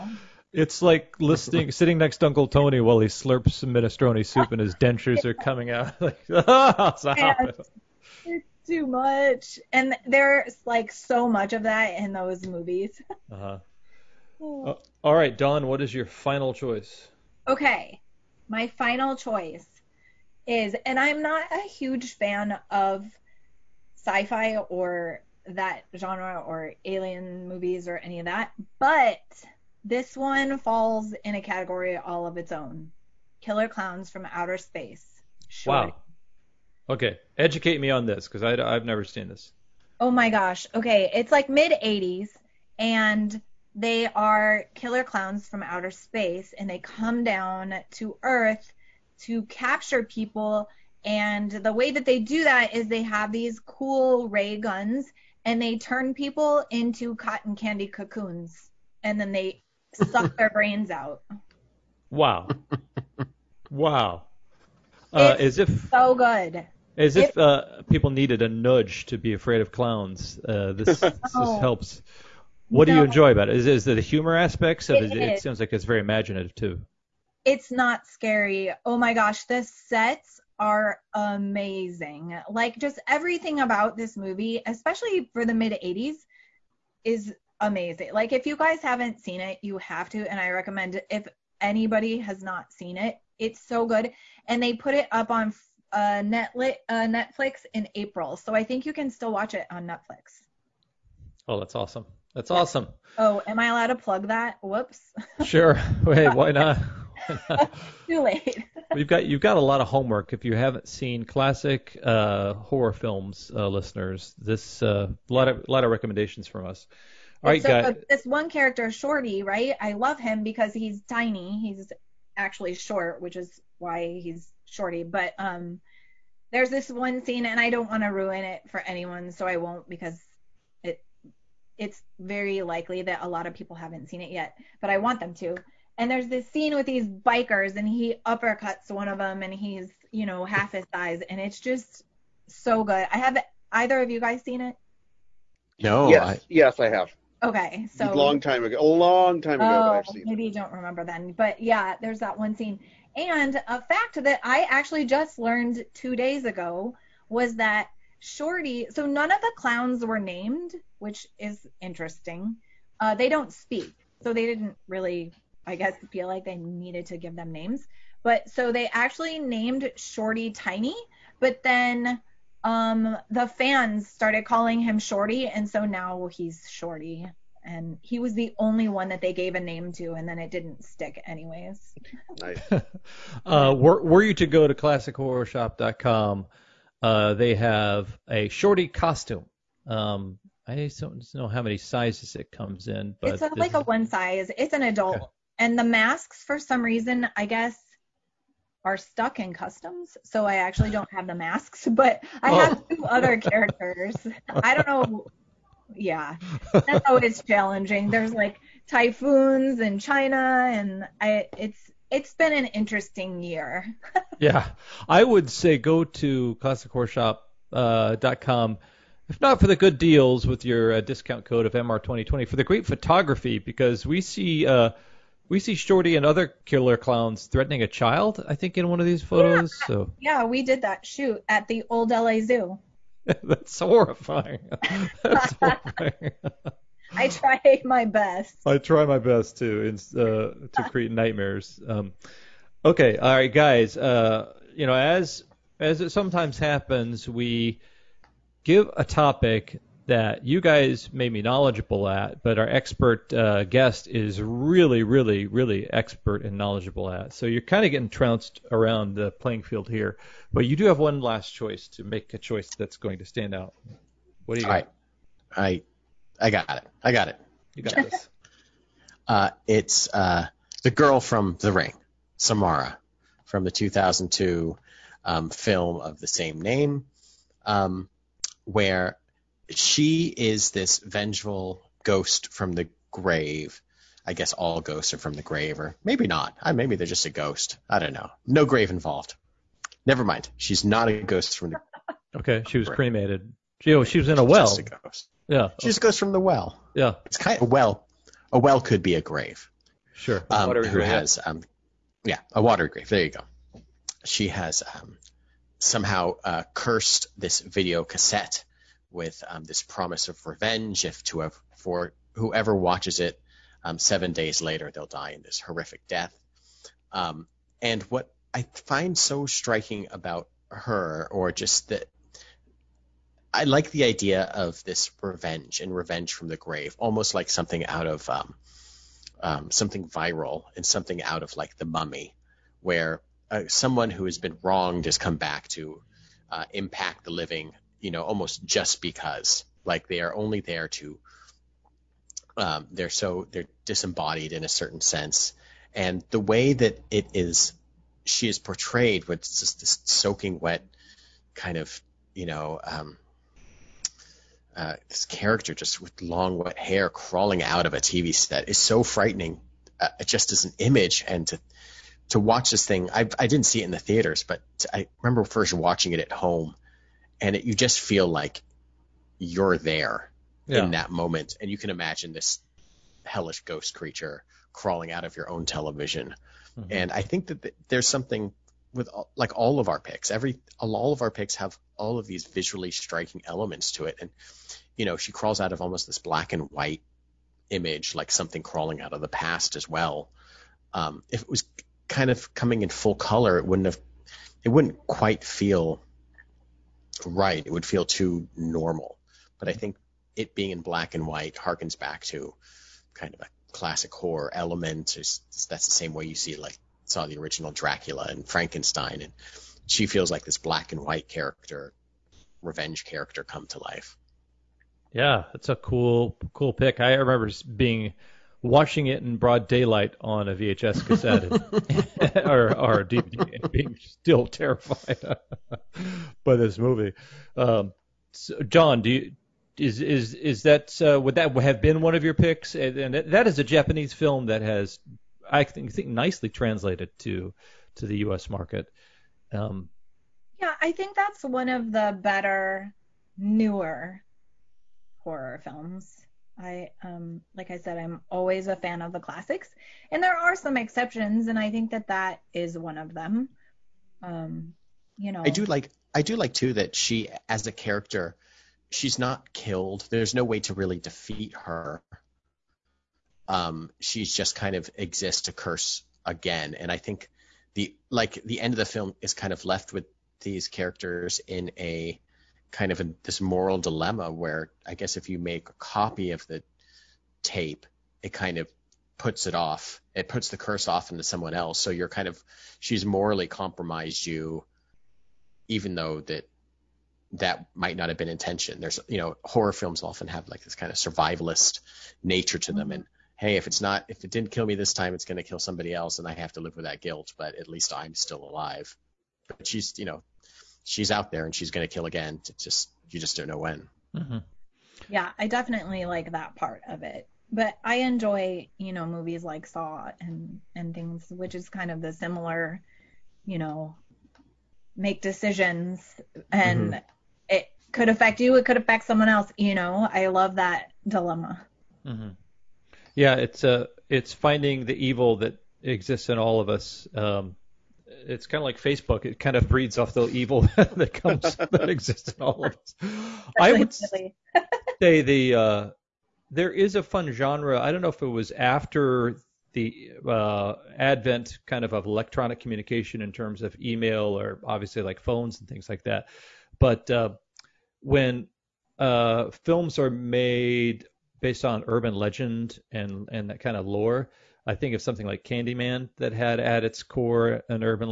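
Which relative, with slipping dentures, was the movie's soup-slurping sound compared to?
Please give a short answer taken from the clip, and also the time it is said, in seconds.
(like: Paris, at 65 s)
Uncle Tony, at 2 s.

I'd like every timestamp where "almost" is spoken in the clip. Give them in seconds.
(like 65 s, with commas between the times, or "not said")
326 s, 338 s, 385 s.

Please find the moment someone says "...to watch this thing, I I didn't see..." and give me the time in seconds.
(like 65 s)
362 s.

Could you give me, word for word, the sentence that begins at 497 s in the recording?
But at least I'm still alive.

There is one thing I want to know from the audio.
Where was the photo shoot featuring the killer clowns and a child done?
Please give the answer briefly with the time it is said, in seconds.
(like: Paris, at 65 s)
the old LA Zoo, at 231 s.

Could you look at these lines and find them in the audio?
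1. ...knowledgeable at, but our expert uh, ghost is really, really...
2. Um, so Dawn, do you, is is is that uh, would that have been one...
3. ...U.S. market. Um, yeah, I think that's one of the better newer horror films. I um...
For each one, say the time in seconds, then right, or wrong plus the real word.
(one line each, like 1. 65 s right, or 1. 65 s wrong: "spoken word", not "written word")
1. 251 s wrong: "guest", not "ghost"
2. 427 s right
3. 438 s right.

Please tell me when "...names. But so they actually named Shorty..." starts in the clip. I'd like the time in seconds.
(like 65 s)
167 s.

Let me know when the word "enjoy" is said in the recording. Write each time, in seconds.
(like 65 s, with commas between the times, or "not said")
73 s, 507 s.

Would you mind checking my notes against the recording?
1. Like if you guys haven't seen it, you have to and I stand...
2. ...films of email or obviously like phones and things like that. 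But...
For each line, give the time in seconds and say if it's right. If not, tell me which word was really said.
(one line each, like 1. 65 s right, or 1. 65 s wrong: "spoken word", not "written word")
1. 88 s wrong: "recommend", not "stand"
2. 543 s wrong: "terms", not "films".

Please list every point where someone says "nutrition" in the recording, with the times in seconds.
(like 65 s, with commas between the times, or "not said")
not said.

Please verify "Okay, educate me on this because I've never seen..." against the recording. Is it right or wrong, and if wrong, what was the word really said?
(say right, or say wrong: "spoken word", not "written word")
right.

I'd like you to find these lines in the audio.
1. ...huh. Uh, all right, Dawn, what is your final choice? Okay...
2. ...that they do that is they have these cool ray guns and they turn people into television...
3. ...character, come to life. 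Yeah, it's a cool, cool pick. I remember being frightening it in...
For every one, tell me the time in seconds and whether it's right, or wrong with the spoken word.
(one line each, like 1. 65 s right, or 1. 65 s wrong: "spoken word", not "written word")
1. 13 s right
2. 51 s wrong: "cotton", not "television"
3. 413 s wrong: "watching", not "frightening".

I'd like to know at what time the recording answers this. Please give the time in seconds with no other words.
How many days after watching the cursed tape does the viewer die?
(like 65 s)
313 s.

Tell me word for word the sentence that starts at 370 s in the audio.
in that moment, and you can imagine this hellish ghost creature crawling out of your own television.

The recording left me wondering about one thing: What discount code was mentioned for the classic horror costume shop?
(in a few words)
MR2020.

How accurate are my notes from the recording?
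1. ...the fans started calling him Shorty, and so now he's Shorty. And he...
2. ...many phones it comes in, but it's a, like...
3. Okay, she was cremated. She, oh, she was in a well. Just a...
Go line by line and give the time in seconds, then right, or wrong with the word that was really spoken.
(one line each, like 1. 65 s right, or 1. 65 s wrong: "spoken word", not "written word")
1. 173 s right
2. 191 s wrong: "sizes", not "phones"
3. 292 s right.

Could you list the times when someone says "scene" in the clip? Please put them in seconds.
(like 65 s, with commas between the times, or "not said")
127 s, 136 s, 152 s.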